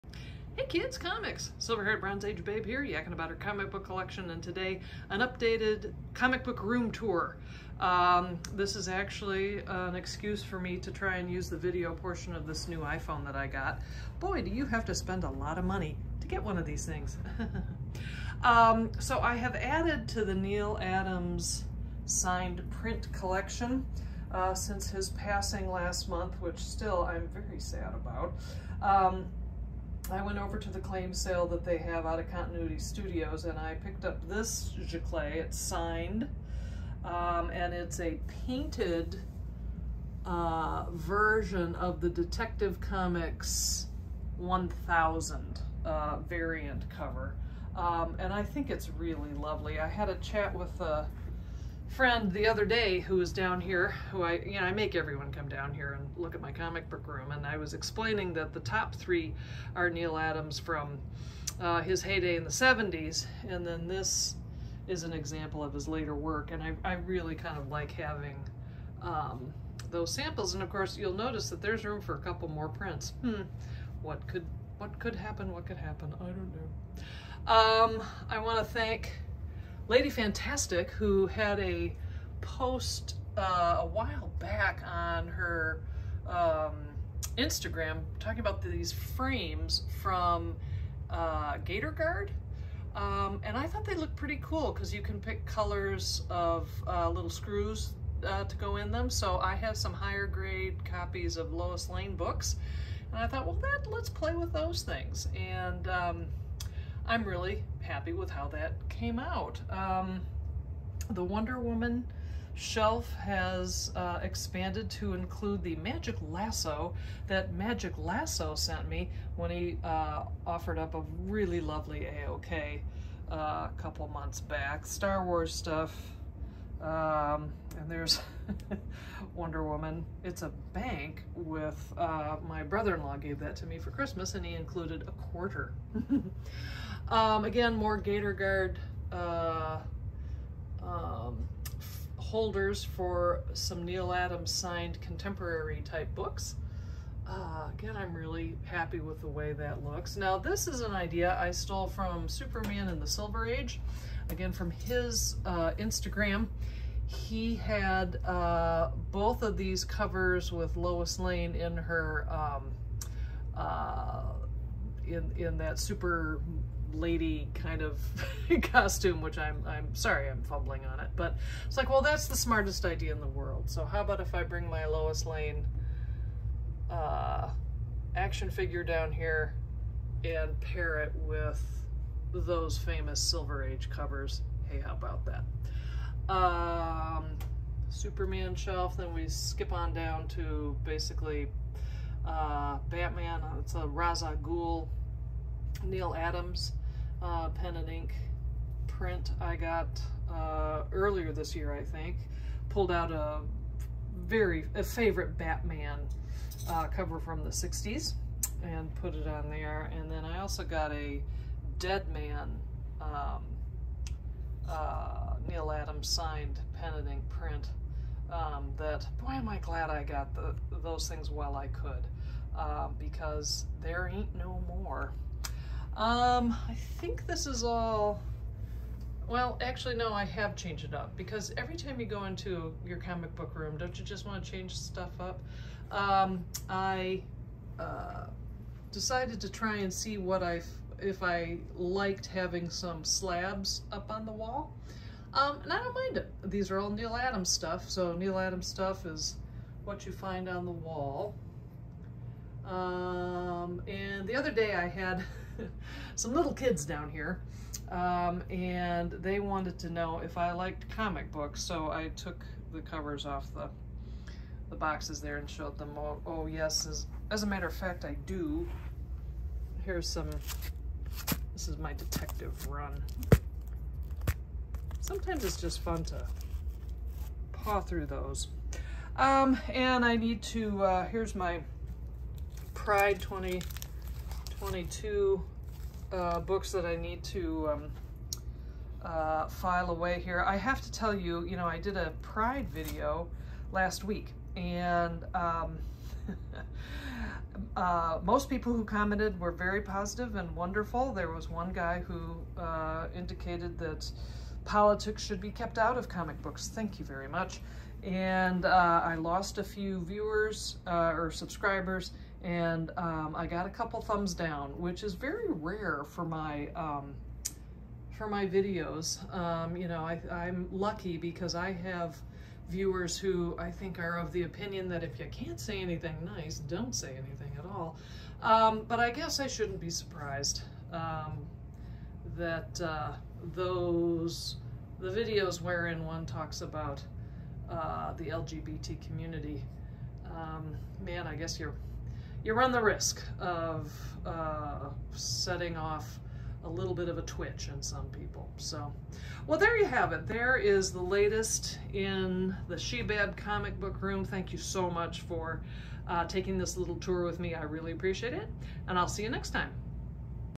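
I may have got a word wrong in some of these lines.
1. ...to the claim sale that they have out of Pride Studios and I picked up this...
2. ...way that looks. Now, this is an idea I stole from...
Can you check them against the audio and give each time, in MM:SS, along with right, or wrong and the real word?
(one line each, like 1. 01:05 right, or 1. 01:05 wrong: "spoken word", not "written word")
1. 00:30 wrong: "Continuity", not "Pride"
2. 02:29 right.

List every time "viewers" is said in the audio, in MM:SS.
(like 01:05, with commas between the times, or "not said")
05:10, 05:22.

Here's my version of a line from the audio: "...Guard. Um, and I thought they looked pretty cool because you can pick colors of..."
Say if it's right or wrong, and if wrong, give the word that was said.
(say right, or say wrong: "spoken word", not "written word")
right.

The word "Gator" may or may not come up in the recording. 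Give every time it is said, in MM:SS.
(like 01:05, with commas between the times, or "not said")
01:31, 02:17.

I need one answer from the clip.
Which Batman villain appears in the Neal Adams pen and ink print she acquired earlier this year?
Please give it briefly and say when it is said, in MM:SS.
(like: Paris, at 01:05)
Ra's al Ghul, at 03:13.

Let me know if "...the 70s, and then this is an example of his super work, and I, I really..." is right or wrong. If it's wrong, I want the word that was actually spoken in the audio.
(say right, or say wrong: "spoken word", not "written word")
wrong: "later", not "super".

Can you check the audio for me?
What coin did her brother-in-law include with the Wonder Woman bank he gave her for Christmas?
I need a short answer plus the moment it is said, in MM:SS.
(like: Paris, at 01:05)
A quarter, at 02:15.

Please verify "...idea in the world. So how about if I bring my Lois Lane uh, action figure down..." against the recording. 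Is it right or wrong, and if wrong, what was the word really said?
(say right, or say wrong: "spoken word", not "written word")
right.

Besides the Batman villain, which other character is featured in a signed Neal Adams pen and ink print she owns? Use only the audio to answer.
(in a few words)
Deadman.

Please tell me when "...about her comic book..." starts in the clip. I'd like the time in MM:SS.
00:03.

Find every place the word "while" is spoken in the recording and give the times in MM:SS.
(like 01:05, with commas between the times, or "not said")
01:23, 03:41.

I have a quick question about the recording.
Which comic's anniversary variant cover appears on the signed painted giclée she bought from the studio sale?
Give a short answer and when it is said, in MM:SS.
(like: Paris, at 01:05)
Detective Comics 1000, at 00:42.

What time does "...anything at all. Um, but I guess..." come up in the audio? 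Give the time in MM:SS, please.
05:27.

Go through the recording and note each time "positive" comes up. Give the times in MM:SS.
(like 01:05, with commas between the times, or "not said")
04:59.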